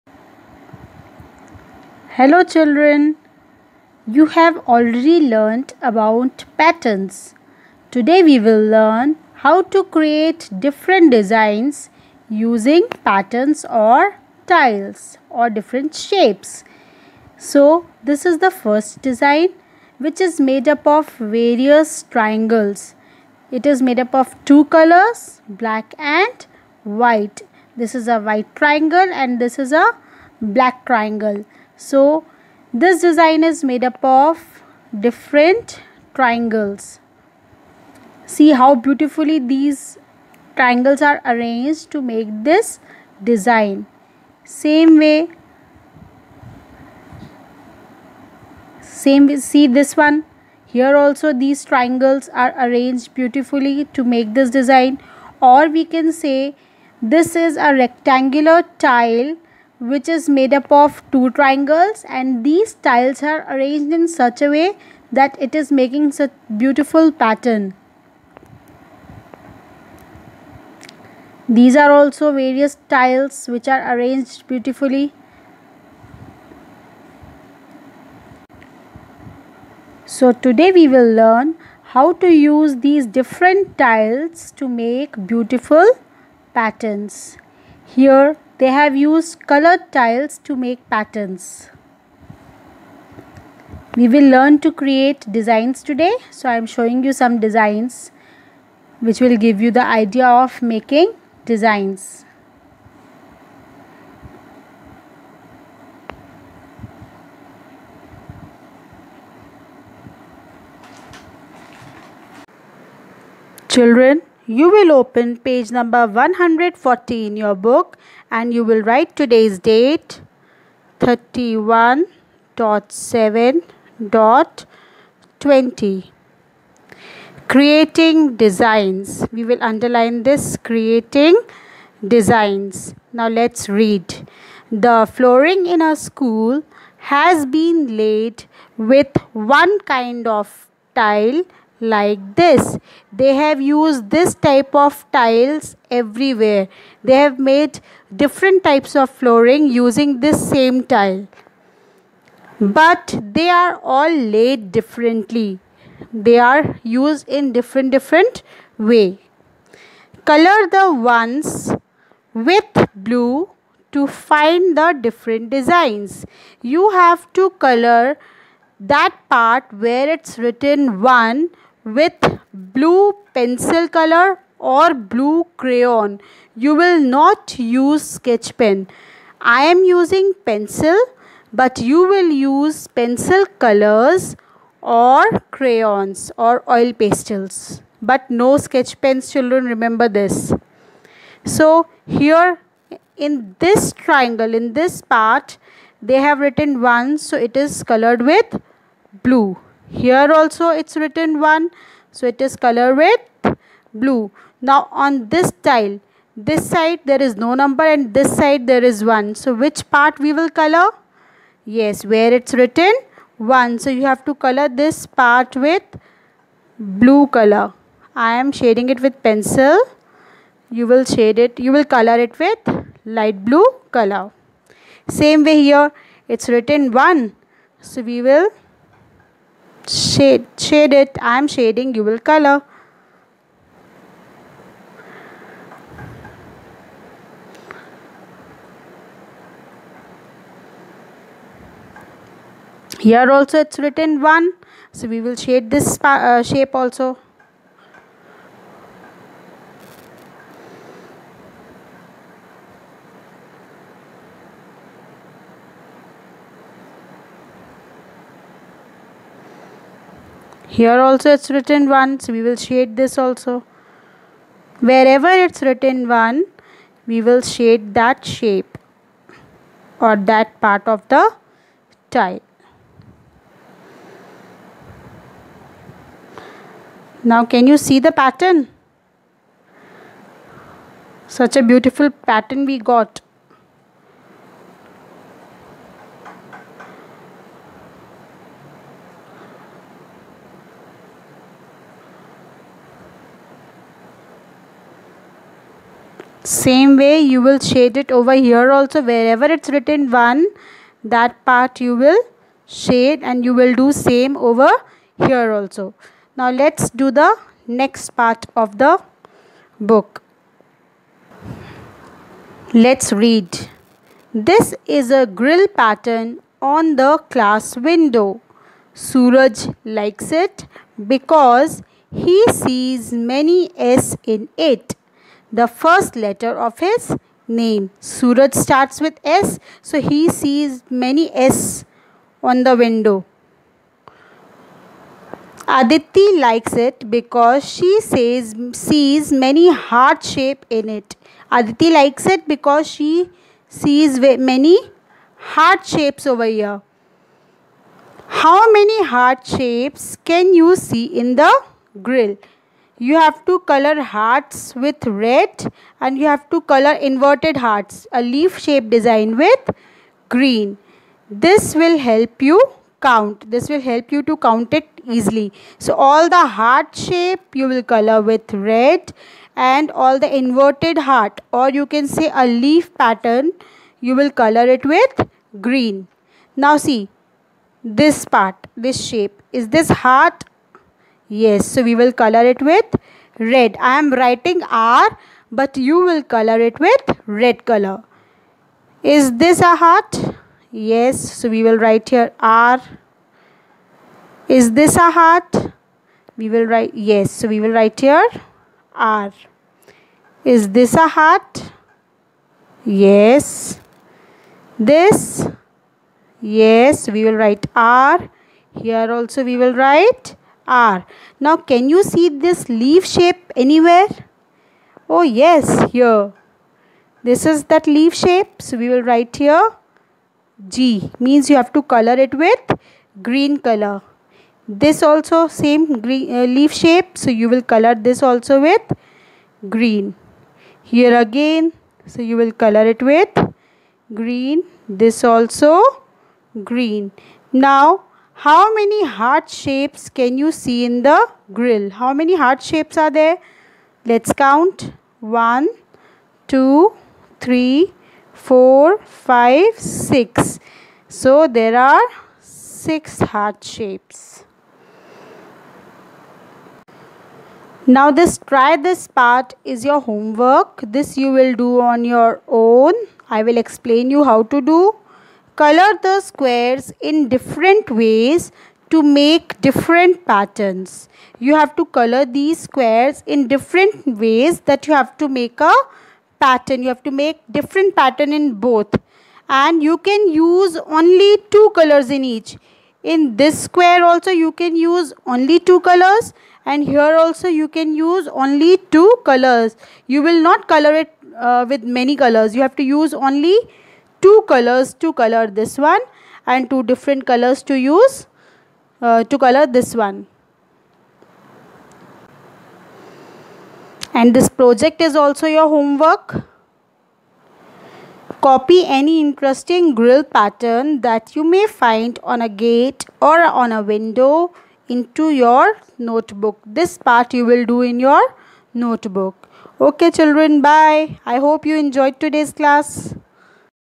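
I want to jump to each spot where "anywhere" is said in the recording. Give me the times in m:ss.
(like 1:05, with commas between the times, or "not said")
6:53.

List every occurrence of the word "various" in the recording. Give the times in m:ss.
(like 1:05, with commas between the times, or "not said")
0:21, 1:12.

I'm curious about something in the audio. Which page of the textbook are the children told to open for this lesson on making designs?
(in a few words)
140.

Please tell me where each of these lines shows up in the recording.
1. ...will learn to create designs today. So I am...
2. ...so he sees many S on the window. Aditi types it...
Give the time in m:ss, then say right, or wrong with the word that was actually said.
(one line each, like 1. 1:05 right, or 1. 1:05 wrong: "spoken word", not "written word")
1. 1:34 right
2. 5:29 wrong: "likes", not "types".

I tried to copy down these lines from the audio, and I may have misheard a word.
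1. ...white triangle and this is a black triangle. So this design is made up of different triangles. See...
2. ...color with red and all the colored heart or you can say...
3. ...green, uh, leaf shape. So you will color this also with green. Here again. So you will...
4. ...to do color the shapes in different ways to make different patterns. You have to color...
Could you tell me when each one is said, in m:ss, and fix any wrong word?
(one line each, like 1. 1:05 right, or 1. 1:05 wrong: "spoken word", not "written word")
1. 0:28 right
2. 6:07 wrong: "inverted", not "colored"
3. 7:05 right
4. 7:44 wrong: "squares", not "shapes".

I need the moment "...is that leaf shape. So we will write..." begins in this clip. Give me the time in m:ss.
6:57.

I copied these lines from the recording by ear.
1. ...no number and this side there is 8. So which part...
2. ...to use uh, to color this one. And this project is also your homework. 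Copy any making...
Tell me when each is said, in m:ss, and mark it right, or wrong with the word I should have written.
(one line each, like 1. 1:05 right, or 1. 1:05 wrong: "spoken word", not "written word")
1. 3:27 wrong: "1", not "8"
2. 8:17 wrong: "interesting", not "making".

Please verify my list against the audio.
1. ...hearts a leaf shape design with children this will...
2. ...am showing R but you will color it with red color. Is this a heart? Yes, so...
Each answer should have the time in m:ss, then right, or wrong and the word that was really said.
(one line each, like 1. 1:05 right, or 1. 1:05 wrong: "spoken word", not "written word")
1. 5:57 wrong: "green", not "children"
2. 6:23 wrong: "writing", not "showing".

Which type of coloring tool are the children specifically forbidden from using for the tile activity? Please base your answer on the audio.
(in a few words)
sketch pens.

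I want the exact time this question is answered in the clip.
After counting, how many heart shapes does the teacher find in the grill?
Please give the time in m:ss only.
7:32.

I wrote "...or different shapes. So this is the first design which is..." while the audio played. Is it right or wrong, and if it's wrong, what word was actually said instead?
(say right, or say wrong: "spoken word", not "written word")
right.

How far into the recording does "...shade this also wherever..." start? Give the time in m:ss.
4:22.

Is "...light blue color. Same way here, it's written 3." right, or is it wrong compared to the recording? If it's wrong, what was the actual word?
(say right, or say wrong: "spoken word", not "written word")
wrong: "1", not "3".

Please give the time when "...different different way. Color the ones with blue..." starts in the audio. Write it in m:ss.
2:37.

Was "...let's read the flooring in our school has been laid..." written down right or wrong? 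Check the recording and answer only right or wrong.
right.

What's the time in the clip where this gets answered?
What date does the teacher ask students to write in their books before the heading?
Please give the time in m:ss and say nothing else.
2:00.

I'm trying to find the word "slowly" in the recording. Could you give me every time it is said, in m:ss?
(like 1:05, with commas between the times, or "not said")
not said.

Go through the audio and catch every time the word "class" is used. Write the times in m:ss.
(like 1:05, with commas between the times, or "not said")
5:17, 8:42.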